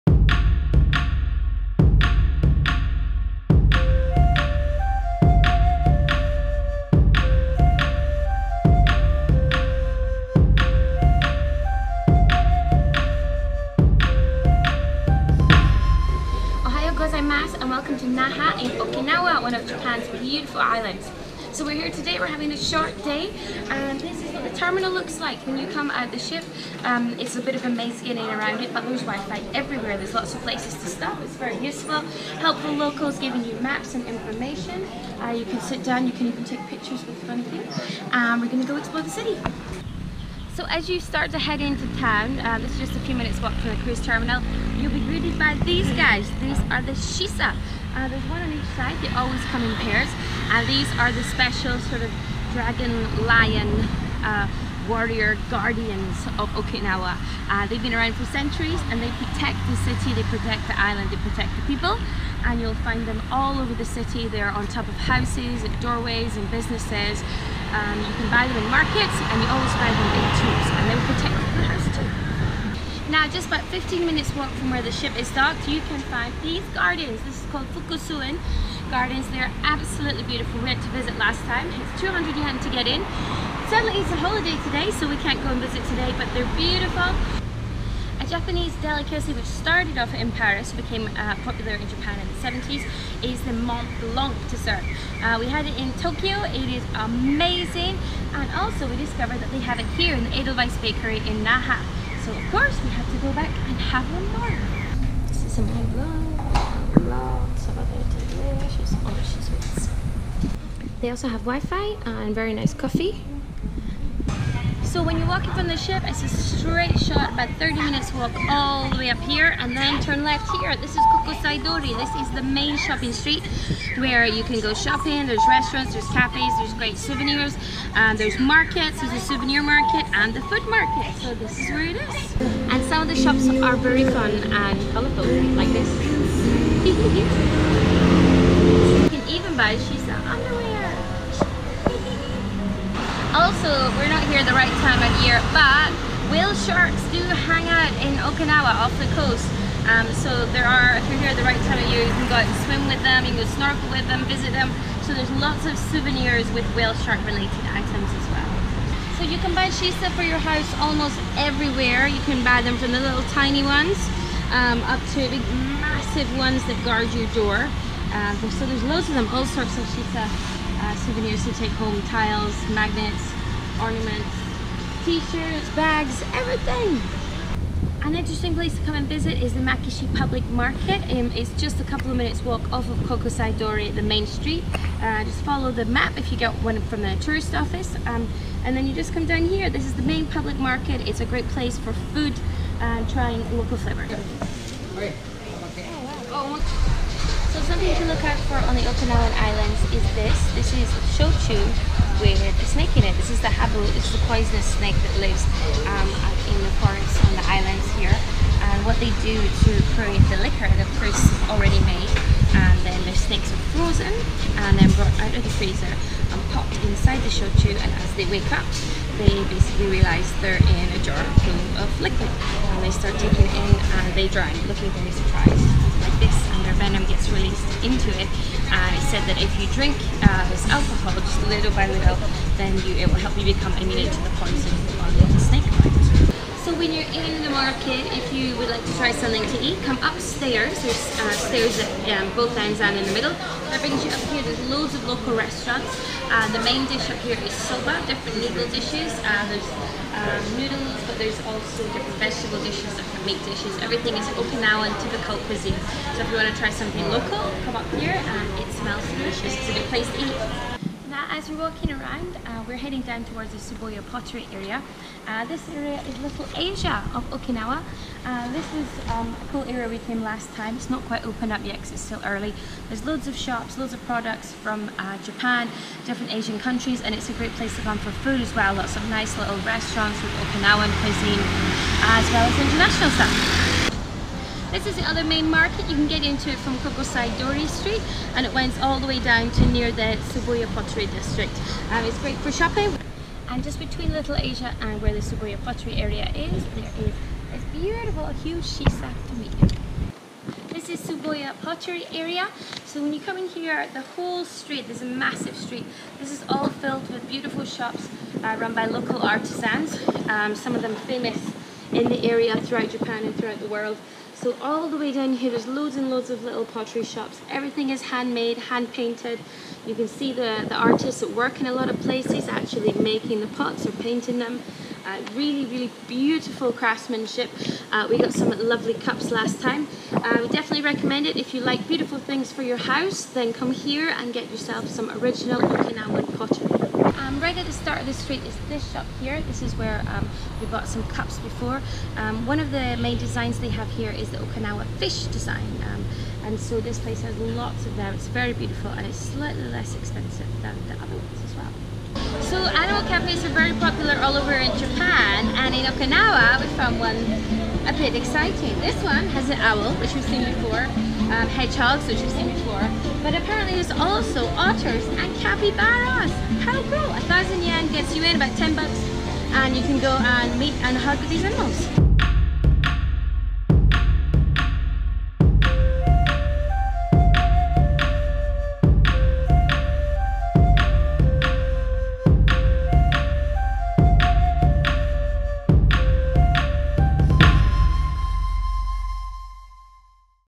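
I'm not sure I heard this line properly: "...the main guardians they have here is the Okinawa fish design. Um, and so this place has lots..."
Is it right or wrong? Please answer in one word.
wrong.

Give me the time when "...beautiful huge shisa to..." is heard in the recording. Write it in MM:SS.
04:57.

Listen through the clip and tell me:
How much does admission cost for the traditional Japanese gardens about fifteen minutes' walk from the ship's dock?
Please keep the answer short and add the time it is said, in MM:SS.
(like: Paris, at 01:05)
200 yen, at 01:22.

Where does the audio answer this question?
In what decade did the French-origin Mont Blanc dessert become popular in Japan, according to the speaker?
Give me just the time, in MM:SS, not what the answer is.
01:32.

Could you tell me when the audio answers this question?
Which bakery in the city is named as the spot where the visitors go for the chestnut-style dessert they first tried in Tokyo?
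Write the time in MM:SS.
01:40.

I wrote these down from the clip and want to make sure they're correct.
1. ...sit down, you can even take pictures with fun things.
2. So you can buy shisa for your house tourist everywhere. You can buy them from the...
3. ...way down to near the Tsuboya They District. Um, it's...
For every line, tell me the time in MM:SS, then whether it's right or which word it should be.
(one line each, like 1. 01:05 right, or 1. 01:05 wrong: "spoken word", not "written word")
1. 00:35 right
2. 02:39 wrong: "almost", not "tourist"
3. 04:49 wrong: "Pottery", not "They".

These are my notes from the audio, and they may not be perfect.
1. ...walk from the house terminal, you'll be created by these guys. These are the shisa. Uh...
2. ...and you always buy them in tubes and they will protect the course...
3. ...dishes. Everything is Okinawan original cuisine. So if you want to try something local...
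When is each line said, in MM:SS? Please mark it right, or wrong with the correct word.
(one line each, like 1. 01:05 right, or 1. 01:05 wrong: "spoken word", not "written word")
1. 00:43 wrong: "cruise", not "house"
2. 01:09 wrong: "house", not "course"
3. 04:13 wrong: "typical", not "original".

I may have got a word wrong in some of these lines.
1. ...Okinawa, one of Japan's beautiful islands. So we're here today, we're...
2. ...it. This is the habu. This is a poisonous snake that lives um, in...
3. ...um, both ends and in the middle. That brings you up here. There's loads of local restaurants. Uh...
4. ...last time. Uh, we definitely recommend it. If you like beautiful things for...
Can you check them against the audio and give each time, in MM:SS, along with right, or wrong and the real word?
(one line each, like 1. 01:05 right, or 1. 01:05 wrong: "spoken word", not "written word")
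1. 00:18 right
2. 03:23 right
3. 04:02 right
4. 05:29 right.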